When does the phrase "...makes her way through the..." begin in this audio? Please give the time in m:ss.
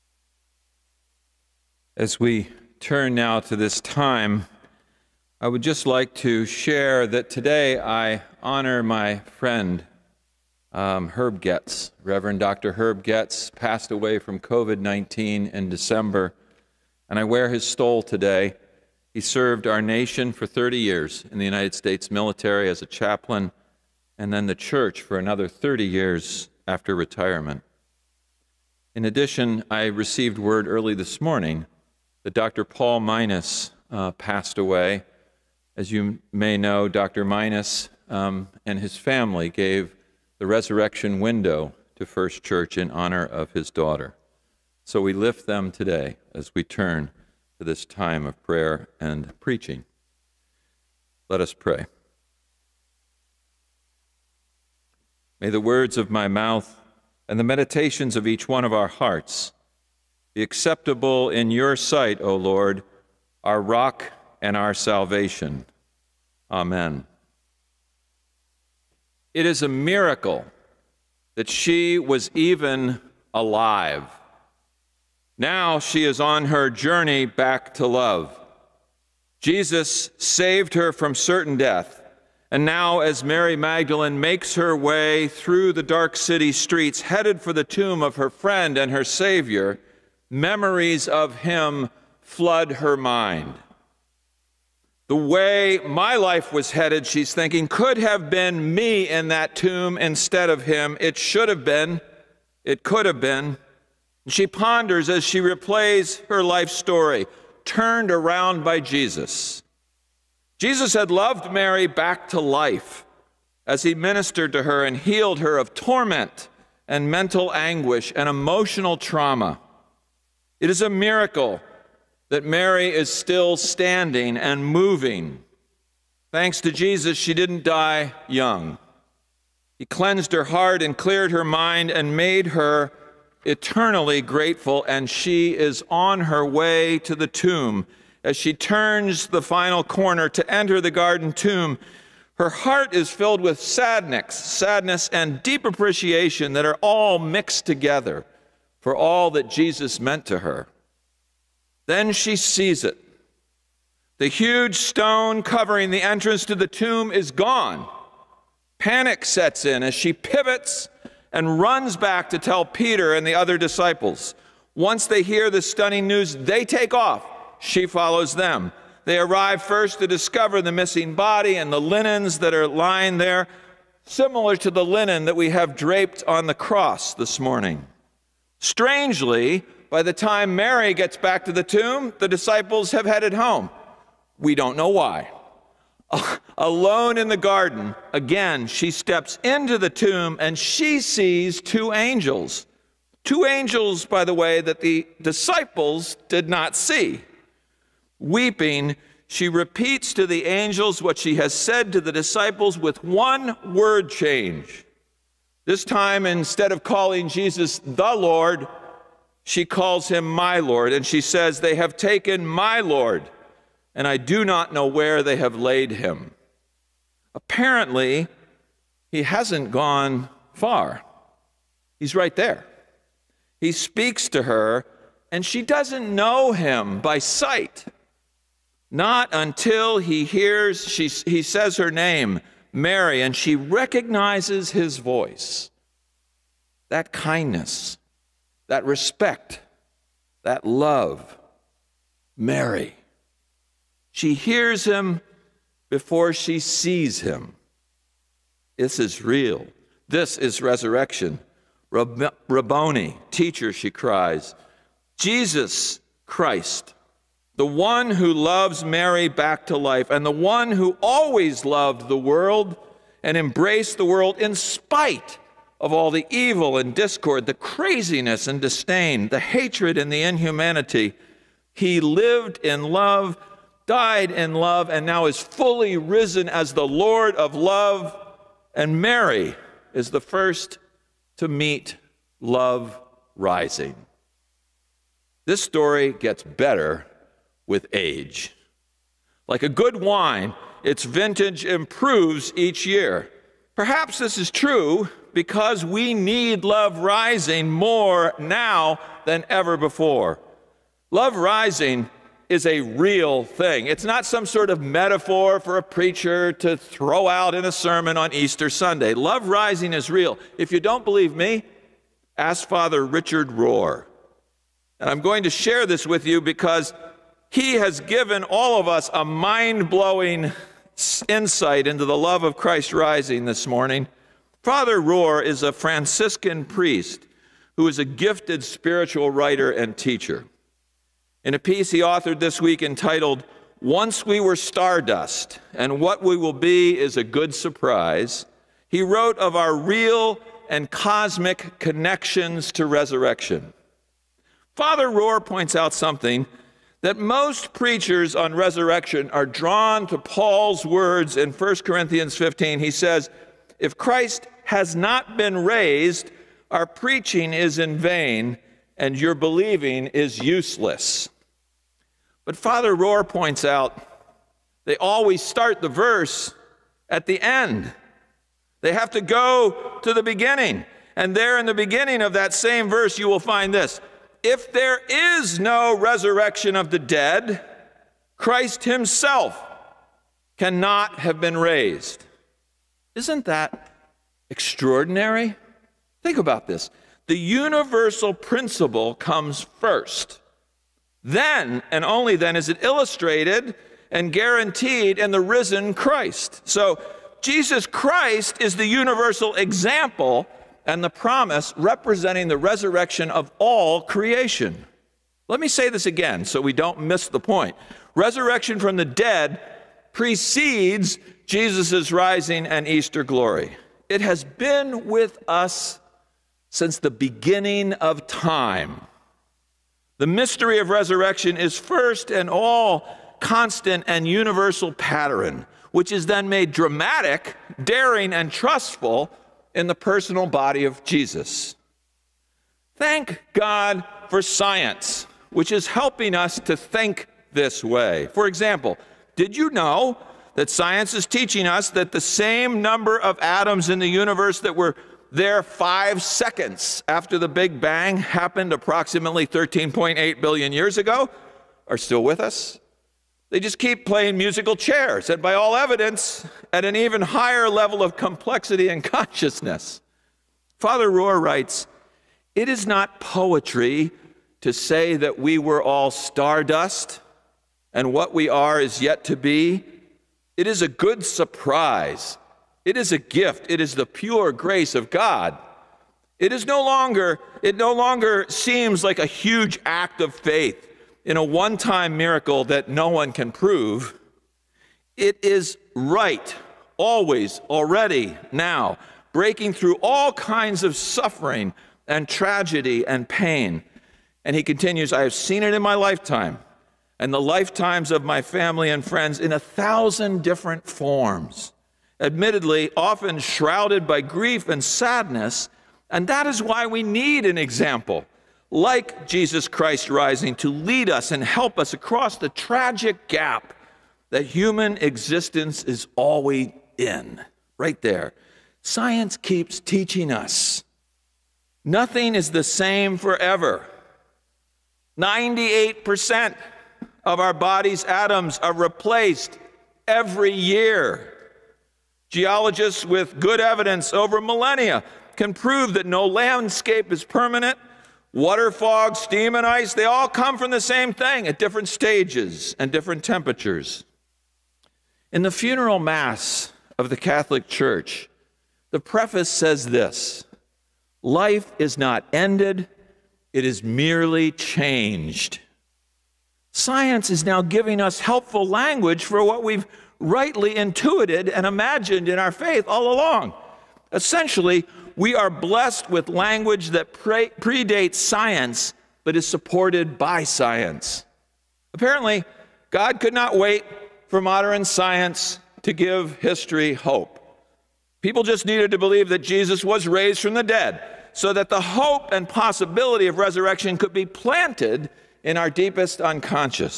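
1:24.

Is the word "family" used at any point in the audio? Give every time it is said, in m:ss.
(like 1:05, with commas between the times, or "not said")
0:38, 8:18.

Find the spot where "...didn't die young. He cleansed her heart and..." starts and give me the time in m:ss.
2:07.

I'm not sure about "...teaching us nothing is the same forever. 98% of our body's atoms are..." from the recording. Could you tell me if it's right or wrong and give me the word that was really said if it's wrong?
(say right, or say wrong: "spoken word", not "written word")
right.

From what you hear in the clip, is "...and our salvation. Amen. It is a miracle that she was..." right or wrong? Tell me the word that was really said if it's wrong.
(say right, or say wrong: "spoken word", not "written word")
right.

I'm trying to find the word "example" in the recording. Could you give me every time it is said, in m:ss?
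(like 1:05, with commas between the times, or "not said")
6:39, 7:18, 8:27.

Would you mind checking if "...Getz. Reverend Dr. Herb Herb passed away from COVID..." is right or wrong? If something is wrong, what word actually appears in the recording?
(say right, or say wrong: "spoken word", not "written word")
wrong: "Getz", not "Herb".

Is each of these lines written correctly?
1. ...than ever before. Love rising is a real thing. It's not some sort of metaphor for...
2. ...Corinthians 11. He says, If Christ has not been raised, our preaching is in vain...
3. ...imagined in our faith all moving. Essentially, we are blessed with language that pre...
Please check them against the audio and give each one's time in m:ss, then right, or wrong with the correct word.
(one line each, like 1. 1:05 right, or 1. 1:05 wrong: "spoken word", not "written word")
1. 4:59 right
2. 5:51 wrong: "15", not "11"
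3. 9:21 wrong: "along", not "moving".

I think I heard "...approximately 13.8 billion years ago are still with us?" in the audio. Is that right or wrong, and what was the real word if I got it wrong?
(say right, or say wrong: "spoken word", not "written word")
right.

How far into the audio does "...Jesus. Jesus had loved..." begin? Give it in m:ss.
1:48.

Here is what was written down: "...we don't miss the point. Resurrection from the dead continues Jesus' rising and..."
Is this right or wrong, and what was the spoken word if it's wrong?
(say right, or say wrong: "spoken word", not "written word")
wrong: "precedes", not "continues".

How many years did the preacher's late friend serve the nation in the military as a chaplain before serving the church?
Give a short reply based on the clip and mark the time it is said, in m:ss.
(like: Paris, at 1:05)
30, at 0:20.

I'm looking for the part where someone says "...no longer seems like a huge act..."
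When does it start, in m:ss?
7:57.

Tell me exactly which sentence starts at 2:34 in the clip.
The huge stone covering the entrance to the tomb is gone.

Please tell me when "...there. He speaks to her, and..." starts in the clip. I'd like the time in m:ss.
3:42.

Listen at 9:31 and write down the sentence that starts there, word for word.
Apparently, God could not wait for modern science to give history hope.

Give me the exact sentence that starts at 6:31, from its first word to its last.
Then, and only then, is it illustrated and guaranteed in the risen Christ.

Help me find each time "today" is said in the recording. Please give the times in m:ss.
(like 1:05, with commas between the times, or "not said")
0:07, 0:18, 0:45.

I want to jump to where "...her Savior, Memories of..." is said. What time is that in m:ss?
1:28.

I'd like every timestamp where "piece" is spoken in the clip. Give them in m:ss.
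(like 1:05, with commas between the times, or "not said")
5:31.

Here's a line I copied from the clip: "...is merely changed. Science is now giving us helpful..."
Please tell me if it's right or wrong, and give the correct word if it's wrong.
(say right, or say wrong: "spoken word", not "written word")
right.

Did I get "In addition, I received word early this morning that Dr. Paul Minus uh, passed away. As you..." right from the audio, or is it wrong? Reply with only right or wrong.
right.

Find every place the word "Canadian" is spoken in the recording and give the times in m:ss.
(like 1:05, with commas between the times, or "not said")
not said.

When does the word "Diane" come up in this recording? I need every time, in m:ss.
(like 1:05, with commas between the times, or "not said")
not said.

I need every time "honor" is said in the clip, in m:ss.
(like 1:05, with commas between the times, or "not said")
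0:08, 0:42.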